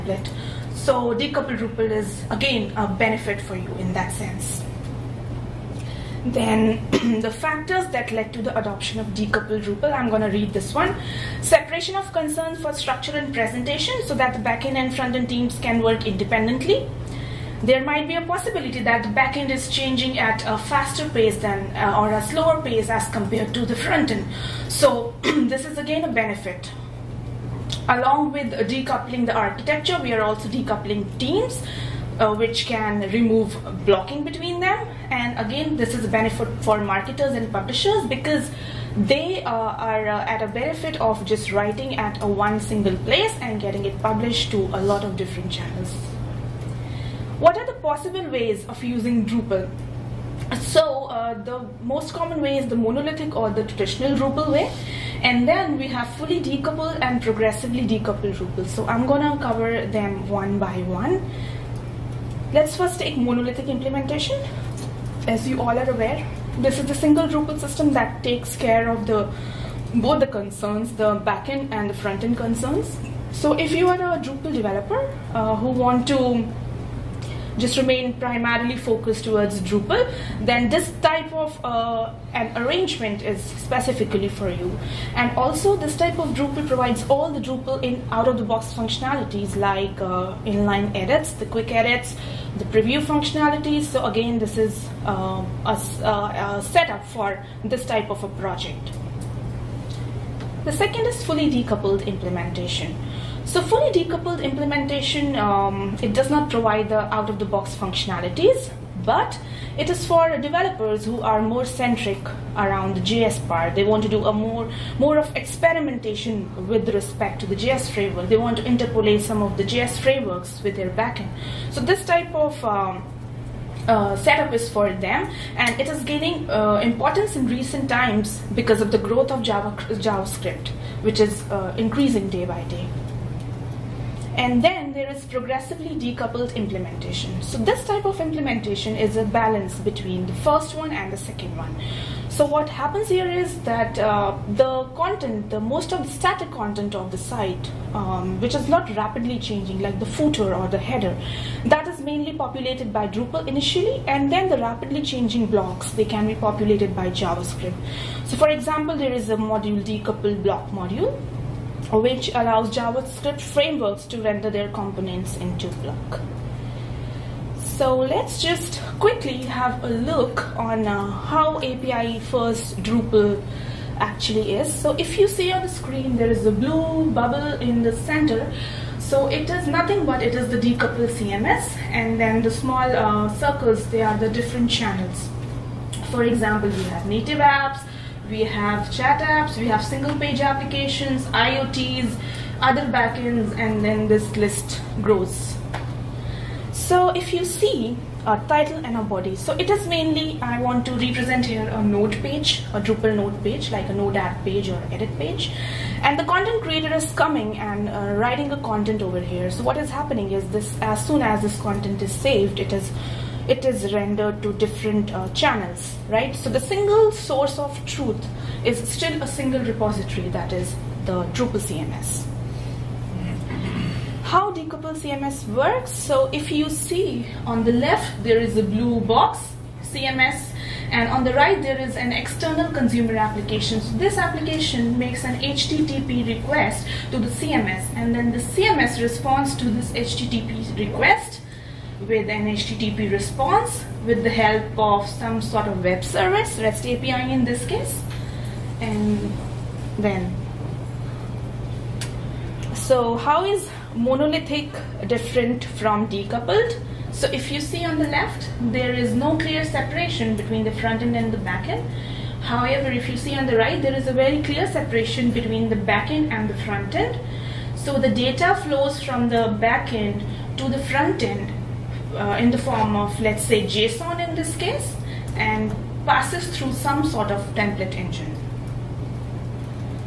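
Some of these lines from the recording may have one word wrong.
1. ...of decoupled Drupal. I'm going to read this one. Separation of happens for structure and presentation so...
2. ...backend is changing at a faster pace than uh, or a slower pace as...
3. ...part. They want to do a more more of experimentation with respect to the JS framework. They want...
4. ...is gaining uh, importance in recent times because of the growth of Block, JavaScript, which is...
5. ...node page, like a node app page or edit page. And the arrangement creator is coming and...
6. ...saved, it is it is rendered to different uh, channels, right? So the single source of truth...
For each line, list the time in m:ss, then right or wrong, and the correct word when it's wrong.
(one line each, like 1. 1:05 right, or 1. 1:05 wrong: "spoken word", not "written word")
1. 0:08 wrong: "concerns", not "happens"
2. 0:19 right
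3. 1:53 right
4. 2:05 wrong: "Java", not "Block"
5. 3:23 wrong: "content", not "arrangement"
6. 3:32 right.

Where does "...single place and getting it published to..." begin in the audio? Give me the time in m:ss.
0:42.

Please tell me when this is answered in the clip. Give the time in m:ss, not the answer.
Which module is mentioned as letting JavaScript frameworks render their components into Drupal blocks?
2:39.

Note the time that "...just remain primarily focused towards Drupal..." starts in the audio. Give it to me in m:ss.
1:17.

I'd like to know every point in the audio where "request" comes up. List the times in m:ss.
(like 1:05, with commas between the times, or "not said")
3:56, 4:00.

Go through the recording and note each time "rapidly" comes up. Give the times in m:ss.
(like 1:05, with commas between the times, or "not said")
2:28, 2:34.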